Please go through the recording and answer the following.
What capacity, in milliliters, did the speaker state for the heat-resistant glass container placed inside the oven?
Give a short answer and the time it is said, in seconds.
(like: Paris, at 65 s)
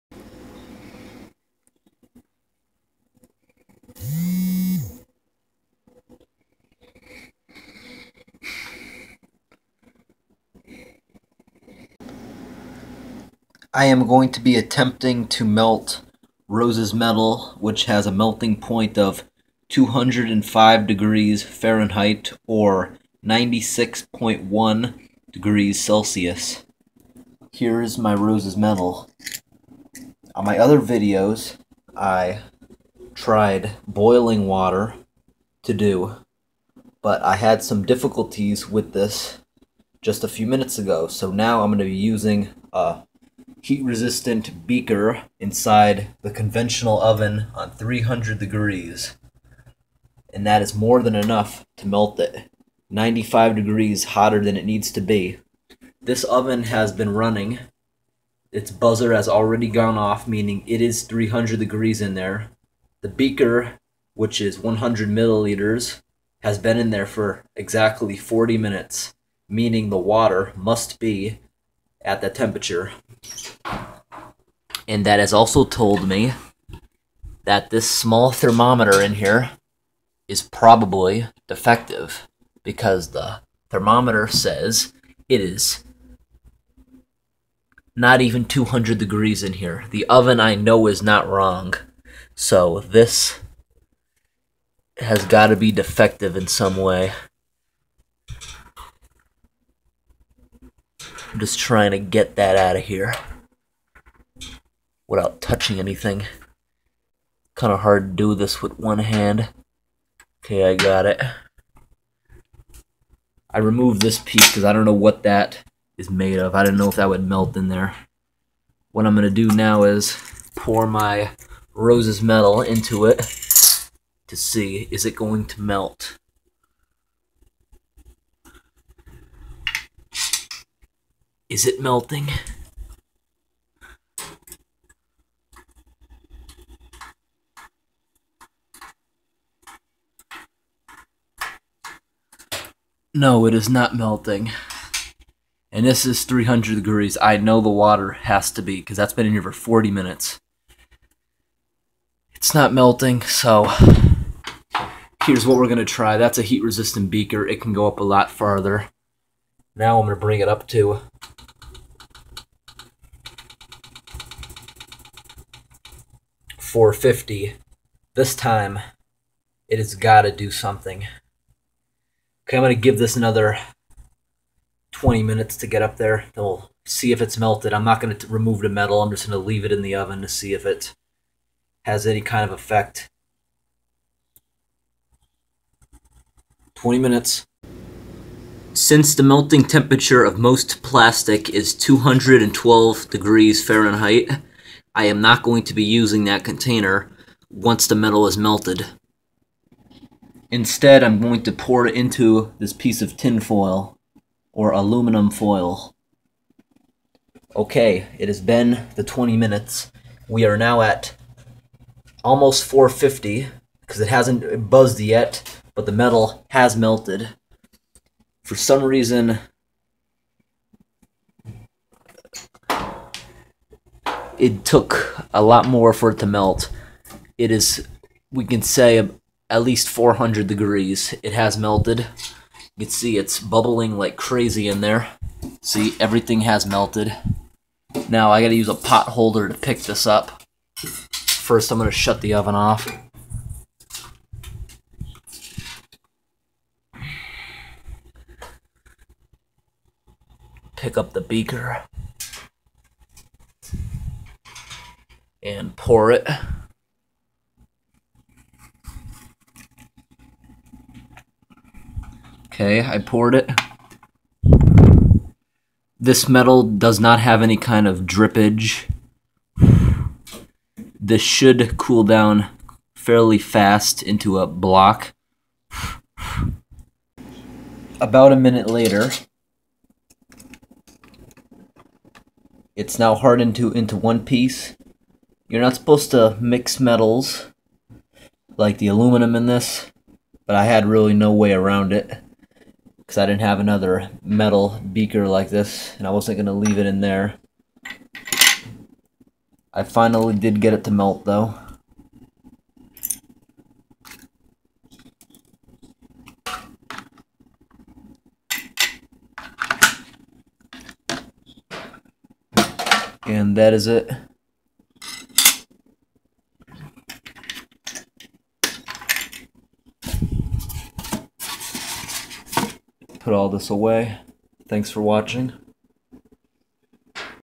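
100 milliliters, at 64 s.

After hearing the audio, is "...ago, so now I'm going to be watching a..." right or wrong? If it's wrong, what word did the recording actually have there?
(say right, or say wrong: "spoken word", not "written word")
wrong: "using", not "watching".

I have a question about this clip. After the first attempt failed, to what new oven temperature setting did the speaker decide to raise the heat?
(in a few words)
450.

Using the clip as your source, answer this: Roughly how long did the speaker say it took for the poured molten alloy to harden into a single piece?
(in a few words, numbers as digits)
About a minute.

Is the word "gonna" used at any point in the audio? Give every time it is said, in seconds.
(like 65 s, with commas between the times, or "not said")
241 s.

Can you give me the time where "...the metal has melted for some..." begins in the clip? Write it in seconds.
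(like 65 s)
215 s.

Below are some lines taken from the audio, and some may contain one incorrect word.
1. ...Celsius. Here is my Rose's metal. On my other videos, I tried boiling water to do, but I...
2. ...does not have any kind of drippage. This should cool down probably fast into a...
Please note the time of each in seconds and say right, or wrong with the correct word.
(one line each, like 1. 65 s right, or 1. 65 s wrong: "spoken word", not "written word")
1. 25 s right
2. 266 s wrong: "fairly", not "probably".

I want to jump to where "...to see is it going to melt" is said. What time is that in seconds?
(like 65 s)
124 s.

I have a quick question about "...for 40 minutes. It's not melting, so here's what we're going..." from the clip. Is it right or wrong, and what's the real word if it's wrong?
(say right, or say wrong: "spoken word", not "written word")
right.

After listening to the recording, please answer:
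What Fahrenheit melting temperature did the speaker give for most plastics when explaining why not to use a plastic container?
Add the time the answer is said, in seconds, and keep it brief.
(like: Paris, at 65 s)
212 degrees Fahrenheit, at 191 s.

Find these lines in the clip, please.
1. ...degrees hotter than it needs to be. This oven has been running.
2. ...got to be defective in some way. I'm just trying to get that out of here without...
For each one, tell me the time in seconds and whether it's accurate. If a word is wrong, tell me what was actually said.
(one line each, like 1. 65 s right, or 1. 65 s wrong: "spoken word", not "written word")
1. 53 s right
2. 95 s right.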